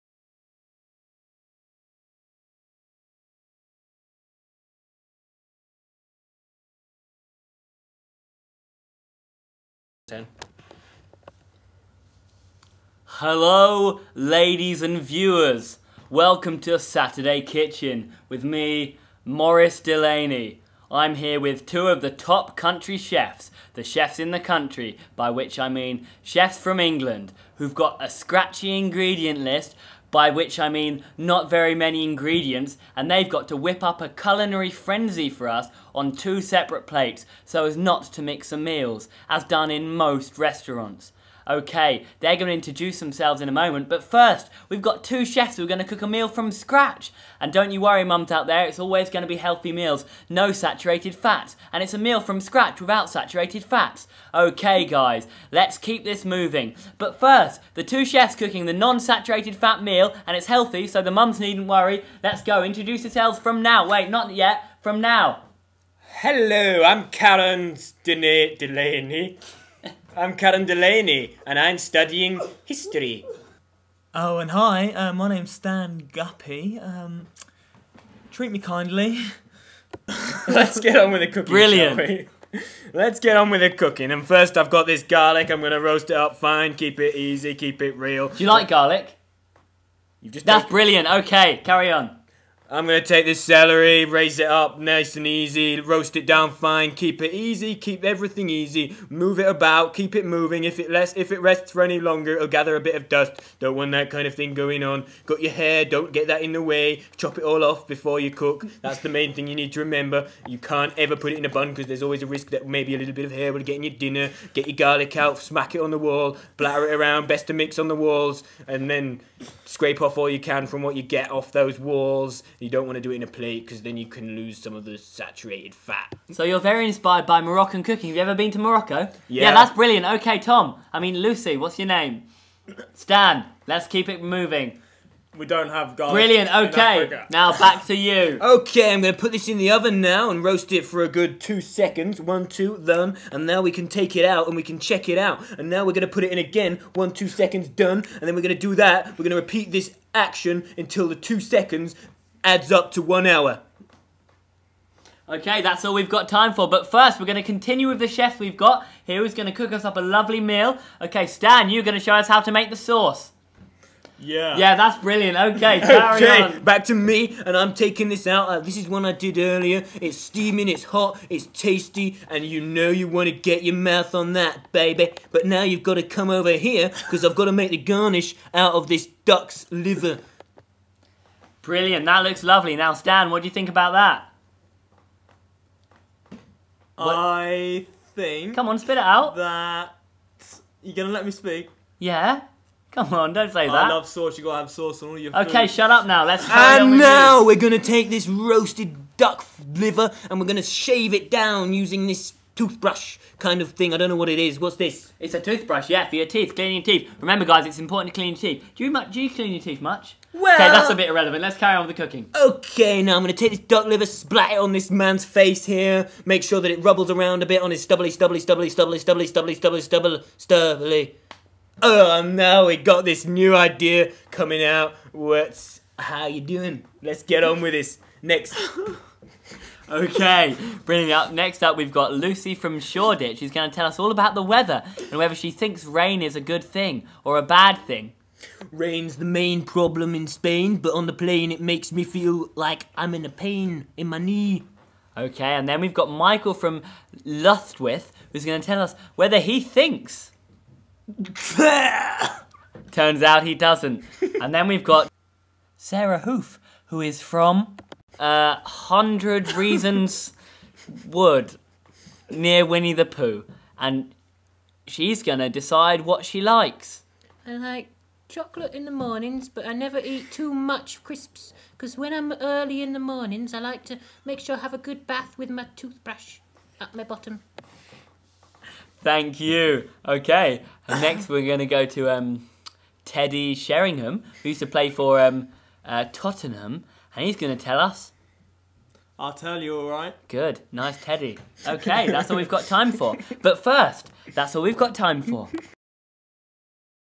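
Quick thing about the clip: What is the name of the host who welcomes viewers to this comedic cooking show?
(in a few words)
Morris Delaney.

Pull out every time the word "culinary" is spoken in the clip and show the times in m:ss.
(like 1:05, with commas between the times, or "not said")
0:34.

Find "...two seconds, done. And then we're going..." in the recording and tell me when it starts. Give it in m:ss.
2:27.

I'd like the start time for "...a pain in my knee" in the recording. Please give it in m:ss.
4:03.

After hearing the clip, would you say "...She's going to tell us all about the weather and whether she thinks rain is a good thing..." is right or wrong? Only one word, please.
right.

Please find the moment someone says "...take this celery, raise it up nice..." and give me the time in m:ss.
1:33.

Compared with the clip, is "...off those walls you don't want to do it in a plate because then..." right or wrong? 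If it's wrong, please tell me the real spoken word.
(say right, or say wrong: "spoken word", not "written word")
right.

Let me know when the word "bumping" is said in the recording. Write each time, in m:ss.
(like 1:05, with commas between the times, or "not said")
not said.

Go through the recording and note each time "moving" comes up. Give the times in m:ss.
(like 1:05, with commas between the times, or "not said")
0:56, 1:40, 2:14.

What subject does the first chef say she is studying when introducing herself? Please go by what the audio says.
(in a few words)
History.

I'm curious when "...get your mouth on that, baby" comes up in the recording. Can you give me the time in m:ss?
2:53.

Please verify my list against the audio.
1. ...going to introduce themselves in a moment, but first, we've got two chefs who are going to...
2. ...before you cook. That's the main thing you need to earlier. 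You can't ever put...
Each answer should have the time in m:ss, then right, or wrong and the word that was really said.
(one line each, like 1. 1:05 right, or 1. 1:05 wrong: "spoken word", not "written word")
1. 0:42 right
2. 1:47 wrong: "remember", not "earlier".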